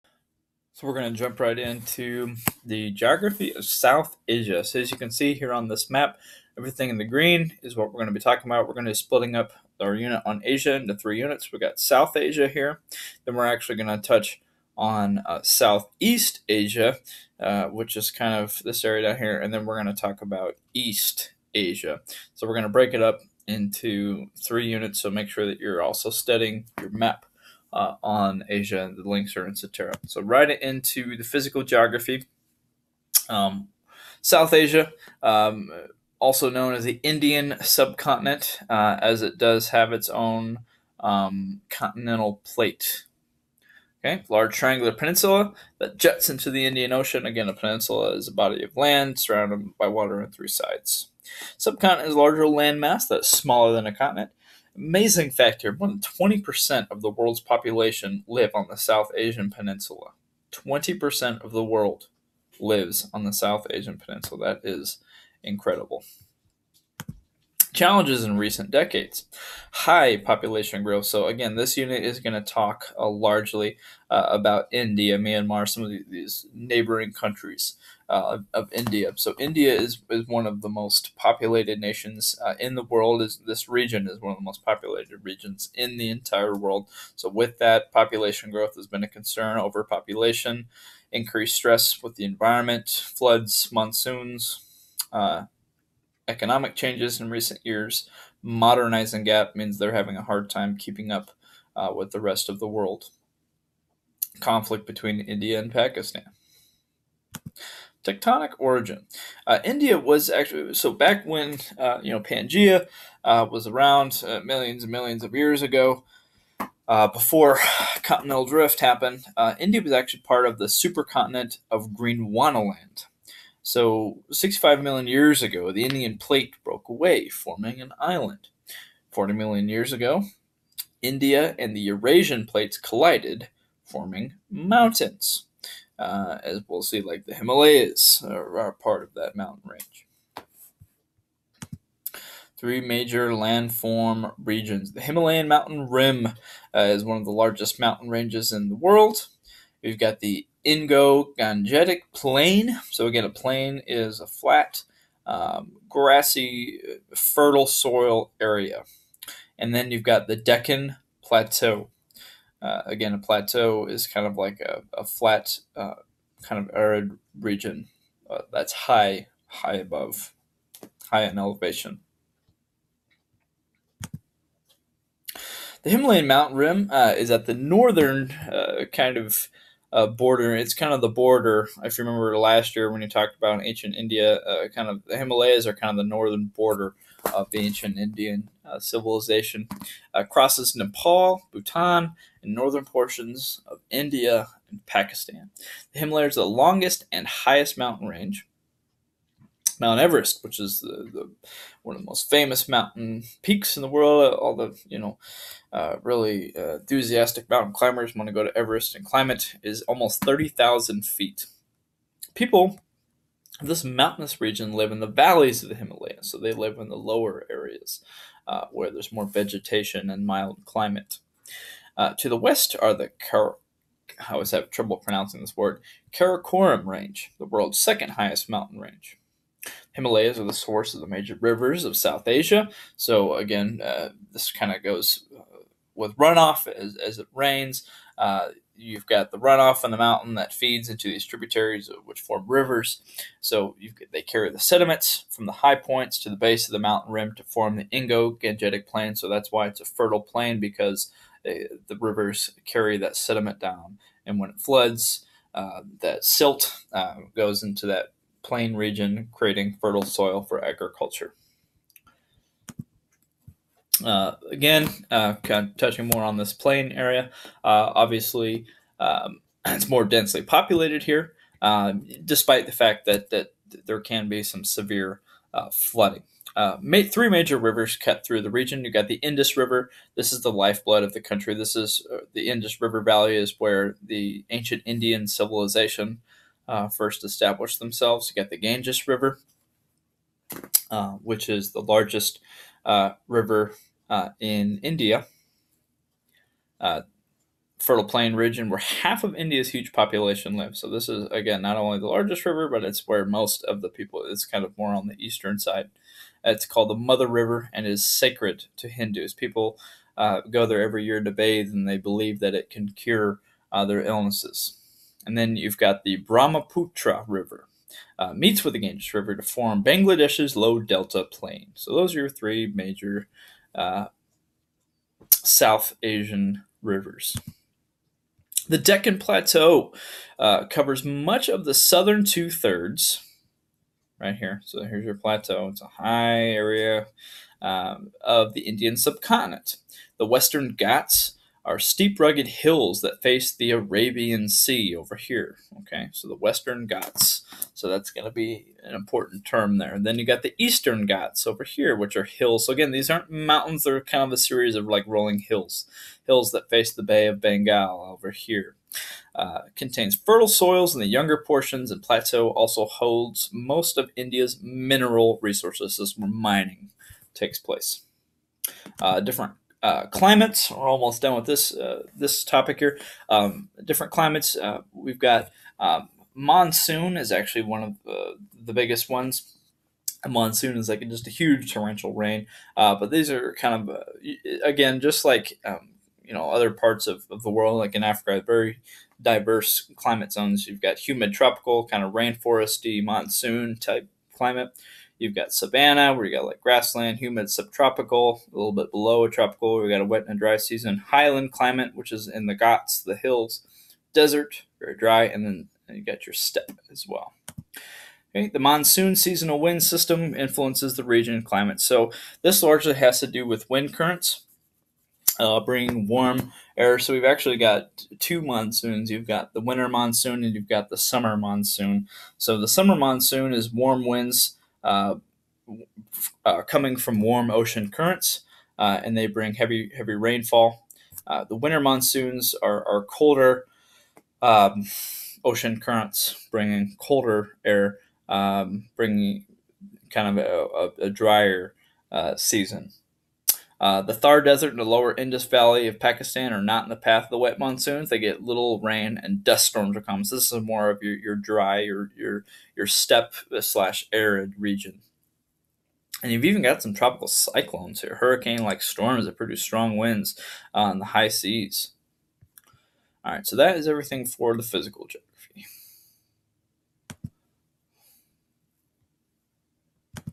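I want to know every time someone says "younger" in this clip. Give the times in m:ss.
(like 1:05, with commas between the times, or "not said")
6:01.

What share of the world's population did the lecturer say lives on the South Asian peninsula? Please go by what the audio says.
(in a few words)
More than 20%.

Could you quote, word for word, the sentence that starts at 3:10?
Uh, crosses Nepal, Bhutan, and northern portions of India and Pakistan.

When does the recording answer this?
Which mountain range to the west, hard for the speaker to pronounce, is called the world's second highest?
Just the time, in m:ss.
3:46.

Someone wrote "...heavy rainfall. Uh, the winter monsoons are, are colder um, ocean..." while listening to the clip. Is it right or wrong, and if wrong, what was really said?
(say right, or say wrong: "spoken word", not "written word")
right.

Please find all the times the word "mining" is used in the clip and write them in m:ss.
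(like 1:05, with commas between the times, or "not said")
6:06.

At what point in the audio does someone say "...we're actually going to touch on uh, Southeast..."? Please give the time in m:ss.
0:13.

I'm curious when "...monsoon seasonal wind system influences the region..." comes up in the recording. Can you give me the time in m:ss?
6:48.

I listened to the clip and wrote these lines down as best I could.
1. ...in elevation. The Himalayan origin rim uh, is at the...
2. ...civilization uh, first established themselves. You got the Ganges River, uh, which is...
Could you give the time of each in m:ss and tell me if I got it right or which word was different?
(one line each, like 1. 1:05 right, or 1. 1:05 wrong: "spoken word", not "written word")
1. 2:51 wrong: "mountain", not "origin"
2. 4:45 right.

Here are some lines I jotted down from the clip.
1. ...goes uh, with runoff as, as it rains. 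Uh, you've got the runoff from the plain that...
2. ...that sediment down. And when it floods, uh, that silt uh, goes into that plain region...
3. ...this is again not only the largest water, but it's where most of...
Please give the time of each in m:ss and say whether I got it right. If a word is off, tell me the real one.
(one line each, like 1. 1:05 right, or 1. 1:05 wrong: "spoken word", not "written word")
1. 3:54 wrong: "mountain", not "plain"
2. 4:12 right
3. 5:00 wrong: "river", not "water".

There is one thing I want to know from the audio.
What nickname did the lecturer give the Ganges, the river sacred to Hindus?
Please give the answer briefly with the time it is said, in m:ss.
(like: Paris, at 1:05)
The Mother River, at 5:06.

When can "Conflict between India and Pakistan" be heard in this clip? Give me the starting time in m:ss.
1:44.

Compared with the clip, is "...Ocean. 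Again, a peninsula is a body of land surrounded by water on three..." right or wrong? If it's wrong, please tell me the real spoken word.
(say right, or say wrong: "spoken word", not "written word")
right.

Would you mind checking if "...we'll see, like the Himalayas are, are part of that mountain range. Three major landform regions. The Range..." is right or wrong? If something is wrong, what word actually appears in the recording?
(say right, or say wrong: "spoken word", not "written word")
wrong: "Himalayan", not "Range".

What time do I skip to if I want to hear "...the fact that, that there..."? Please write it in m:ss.
4:32.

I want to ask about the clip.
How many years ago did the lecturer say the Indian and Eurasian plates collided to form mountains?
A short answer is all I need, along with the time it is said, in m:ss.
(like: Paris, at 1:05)
40 million years ago, at 2:09.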